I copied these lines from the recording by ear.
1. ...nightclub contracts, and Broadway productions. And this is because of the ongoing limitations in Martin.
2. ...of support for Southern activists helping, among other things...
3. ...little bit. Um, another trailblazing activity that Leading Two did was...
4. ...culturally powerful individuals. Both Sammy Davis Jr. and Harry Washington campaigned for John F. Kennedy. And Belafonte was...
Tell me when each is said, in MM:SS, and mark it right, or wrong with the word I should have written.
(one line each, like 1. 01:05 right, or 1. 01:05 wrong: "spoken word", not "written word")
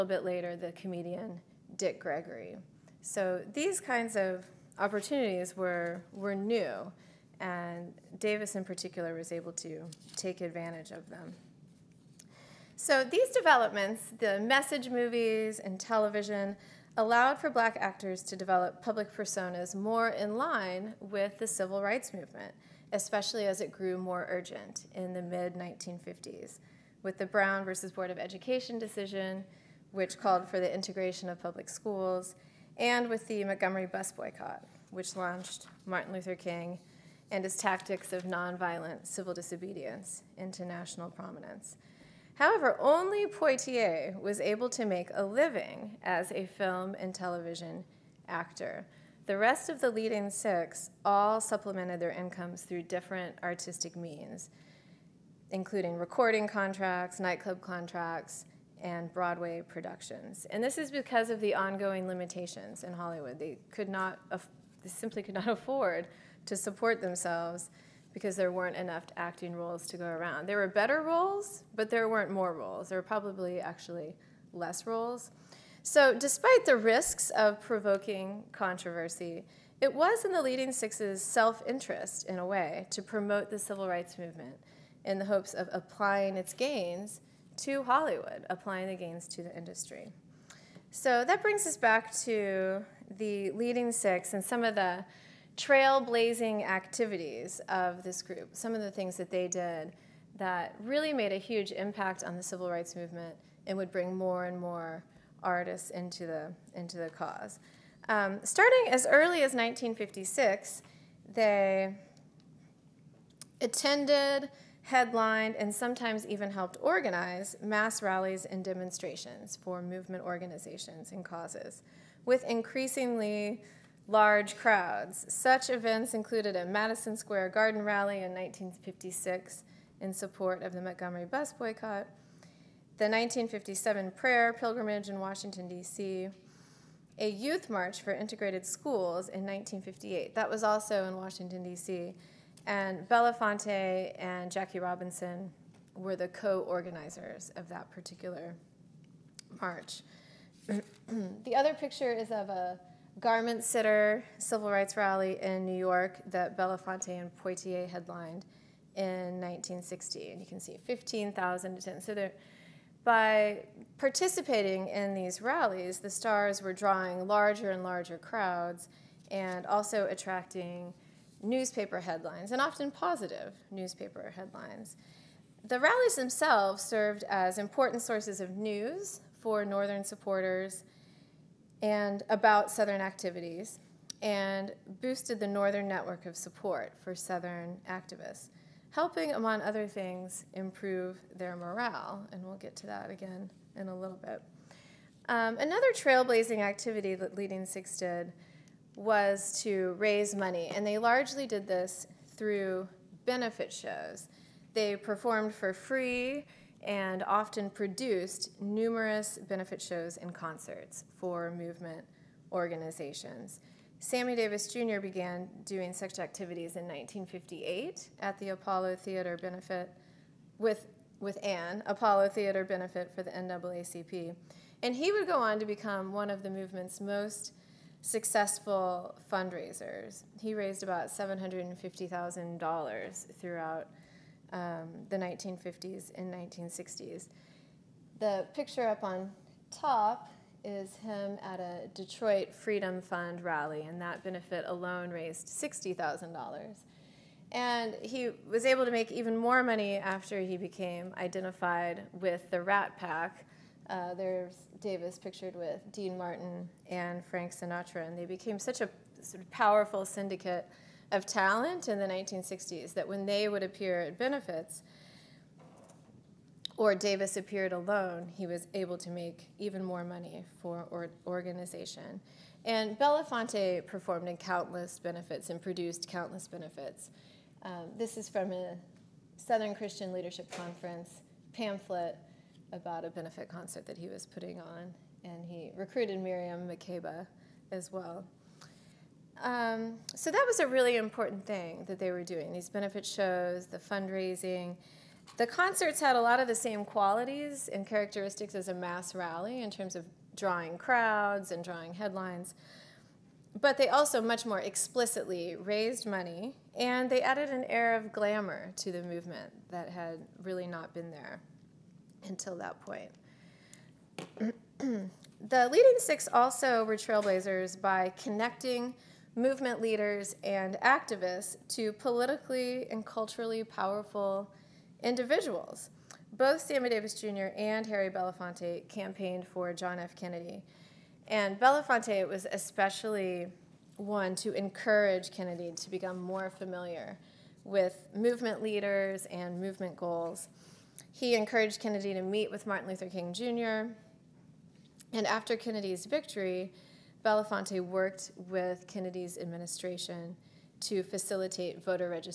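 1. 00:57 wrong: "Hollywood", not "Martin"
2. 03:06 right
3. 03:13 wrong: "Six", not "Two"
4. 05:23 wrong: "Belafonte", not "Washington".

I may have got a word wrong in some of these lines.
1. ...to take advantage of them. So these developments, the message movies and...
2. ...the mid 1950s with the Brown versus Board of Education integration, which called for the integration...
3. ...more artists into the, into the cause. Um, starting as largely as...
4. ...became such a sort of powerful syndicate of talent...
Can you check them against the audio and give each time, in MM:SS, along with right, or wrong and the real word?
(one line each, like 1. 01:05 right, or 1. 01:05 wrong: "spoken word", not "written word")
1. 00:09 right
2. 00:25 wrong: "decision", not "integration"
3. 01:44 wrong: "early", not "largely"
4. 04:18 right.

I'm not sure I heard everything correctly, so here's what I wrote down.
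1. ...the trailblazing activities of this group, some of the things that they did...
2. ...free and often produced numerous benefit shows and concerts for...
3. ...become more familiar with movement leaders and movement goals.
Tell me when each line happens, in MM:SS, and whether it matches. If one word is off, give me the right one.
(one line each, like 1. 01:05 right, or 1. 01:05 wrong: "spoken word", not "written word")
1. 01:34 right
2. 03:25 right
3. 05:35 right.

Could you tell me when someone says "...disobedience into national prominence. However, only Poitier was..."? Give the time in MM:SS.
00:39.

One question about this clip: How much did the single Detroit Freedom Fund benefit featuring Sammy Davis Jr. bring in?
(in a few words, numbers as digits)
$60,000.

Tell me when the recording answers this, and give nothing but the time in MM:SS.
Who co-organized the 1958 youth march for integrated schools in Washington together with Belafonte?
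02:24.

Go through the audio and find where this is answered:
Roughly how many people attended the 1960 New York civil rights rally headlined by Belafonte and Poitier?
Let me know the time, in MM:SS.
02:40.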